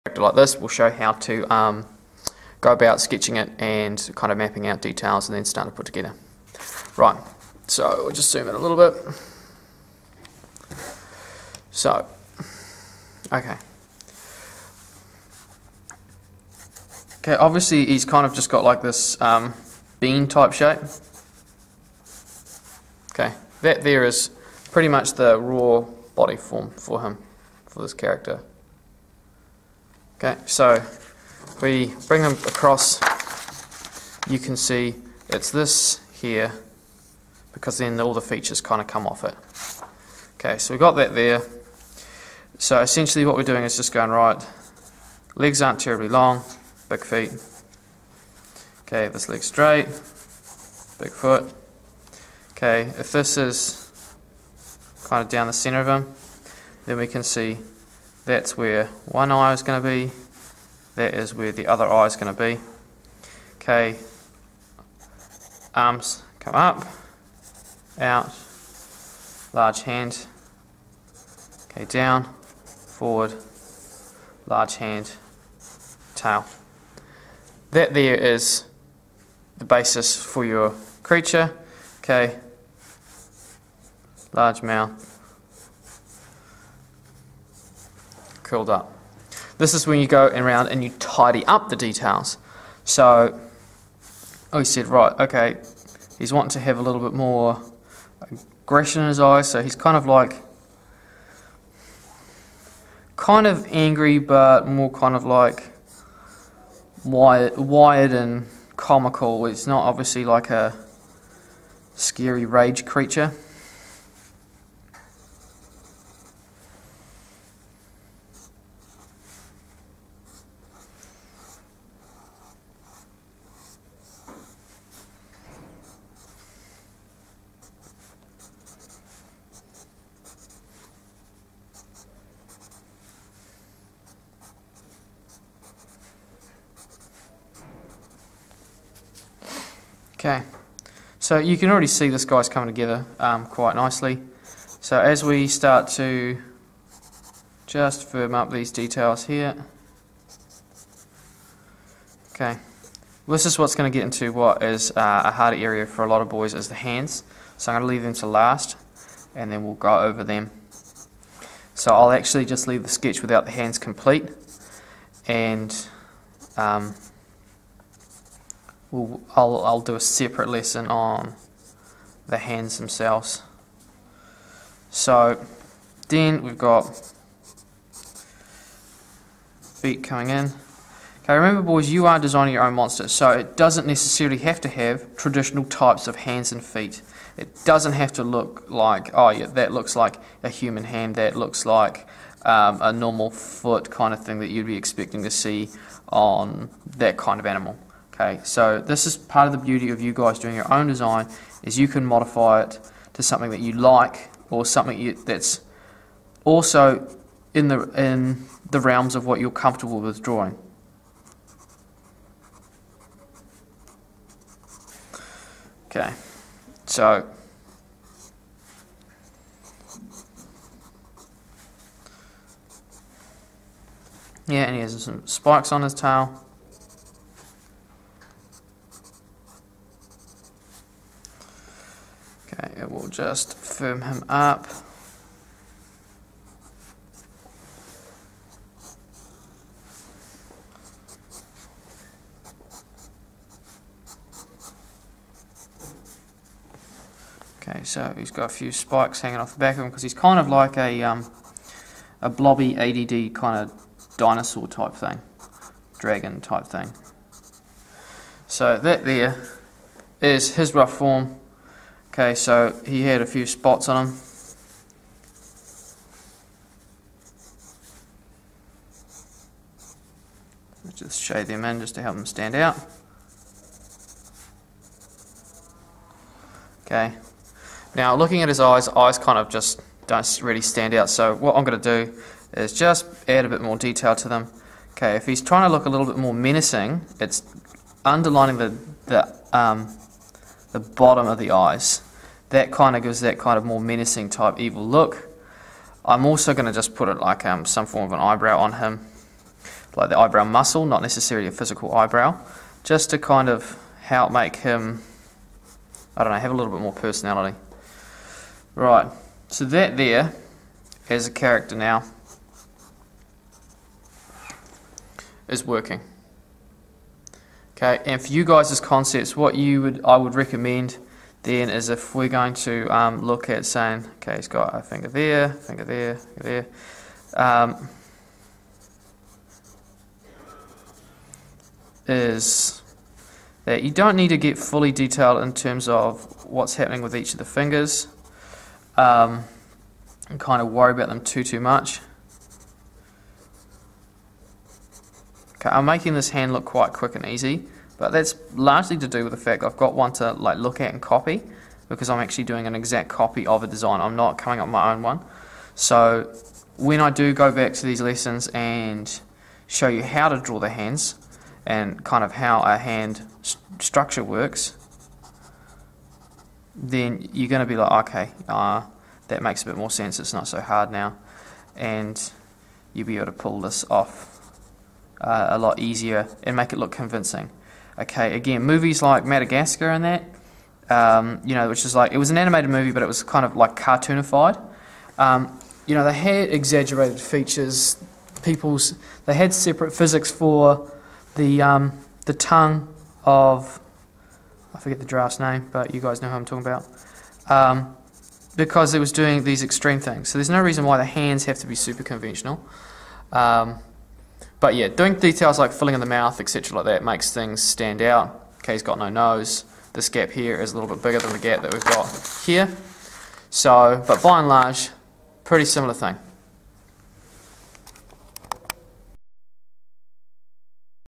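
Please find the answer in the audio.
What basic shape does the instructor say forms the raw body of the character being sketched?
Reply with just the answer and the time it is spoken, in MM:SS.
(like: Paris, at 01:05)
Bean, at 00:19.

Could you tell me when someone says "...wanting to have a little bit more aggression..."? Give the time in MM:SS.
01:36.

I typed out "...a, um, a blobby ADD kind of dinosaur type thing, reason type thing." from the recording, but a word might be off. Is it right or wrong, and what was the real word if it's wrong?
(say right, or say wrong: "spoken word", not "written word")
wrong: "dragon", not "reason".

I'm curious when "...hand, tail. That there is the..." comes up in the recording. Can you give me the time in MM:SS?
01:14.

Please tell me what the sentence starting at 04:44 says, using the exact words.
Okay, if he's trying to look a little bit more menacing, it's underlining the, the um, the bottom of the eyes.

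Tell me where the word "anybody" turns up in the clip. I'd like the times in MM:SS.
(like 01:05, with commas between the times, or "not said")
not said.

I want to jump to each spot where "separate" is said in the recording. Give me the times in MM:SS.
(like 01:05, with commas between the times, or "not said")
02:49, 06:29.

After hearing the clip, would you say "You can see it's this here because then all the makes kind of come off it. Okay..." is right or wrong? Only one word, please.
wrong.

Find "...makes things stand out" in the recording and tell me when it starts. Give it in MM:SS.
06:47.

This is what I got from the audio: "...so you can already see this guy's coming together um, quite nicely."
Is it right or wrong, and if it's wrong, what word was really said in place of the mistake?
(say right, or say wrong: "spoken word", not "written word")
right.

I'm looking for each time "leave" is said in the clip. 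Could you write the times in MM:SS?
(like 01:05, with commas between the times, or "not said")
02:37, 02:42.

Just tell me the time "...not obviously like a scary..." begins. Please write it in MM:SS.
01:49.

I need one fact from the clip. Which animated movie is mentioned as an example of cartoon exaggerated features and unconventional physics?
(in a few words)
Madagascar.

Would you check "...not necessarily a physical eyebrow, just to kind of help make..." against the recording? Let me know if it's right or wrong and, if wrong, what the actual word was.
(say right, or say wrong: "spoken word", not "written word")
right.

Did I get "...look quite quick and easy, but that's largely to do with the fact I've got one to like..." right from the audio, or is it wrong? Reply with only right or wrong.
right.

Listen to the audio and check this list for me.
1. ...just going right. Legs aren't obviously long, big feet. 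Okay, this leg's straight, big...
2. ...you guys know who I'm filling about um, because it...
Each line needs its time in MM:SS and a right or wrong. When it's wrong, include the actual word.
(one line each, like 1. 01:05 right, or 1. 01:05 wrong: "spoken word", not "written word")
1. 00:43 wrong: "terribly", not "obviously"
2. 06:35 wrong: "talking", not "filling".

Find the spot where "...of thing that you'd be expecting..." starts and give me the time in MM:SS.
03:14.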